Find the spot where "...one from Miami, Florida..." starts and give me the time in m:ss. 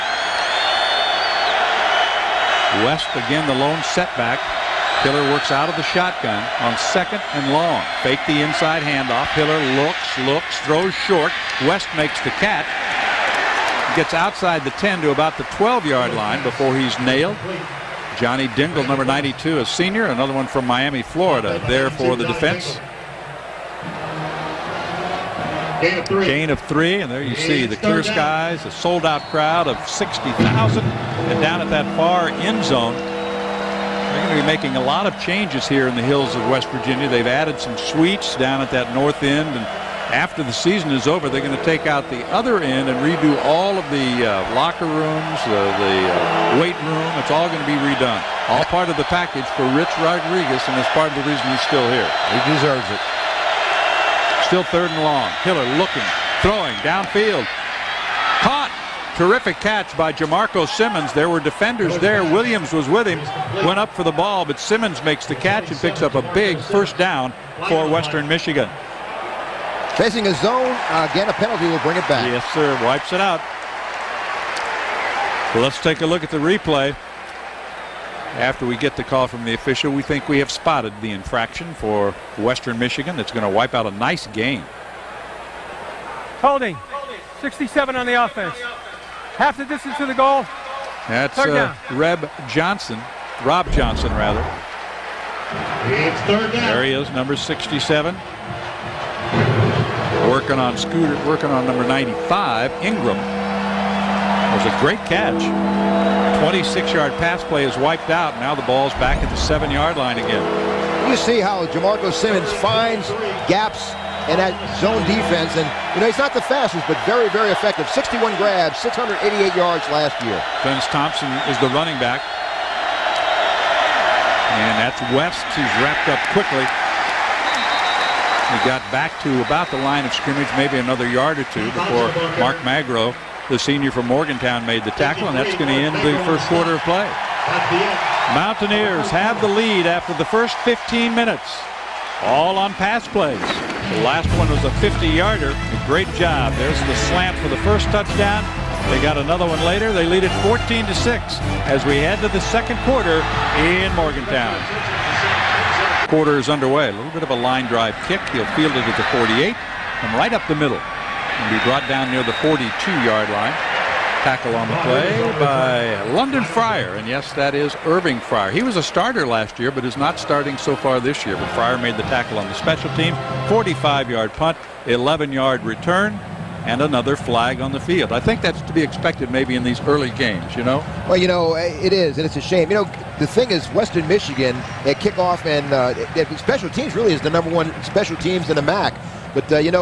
0:20.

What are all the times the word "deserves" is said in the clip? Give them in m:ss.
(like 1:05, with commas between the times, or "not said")
0:52.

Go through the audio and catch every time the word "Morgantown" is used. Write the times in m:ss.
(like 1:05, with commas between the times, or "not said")
2:14, 2:33.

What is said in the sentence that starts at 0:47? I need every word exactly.
It's all going to be redone.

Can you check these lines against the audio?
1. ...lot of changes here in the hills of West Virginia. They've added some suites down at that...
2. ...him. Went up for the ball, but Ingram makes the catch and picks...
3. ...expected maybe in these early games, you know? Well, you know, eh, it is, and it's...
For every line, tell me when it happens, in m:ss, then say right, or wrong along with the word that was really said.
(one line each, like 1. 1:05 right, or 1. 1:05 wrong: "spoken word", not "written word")
1. 0:34 right
2. 1:03 wrong: "Simmons", not "Ingram"
3. 2:58 right.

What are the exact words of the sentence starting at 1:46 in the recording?
26-yard pass play is wiped out.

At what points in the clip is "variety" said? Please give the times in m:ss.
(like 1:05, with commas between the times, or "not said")
not said.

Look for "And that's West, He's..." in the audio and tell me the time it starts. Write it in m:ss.
2:04.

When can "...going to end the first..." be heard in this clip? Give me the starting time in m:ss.
2:15.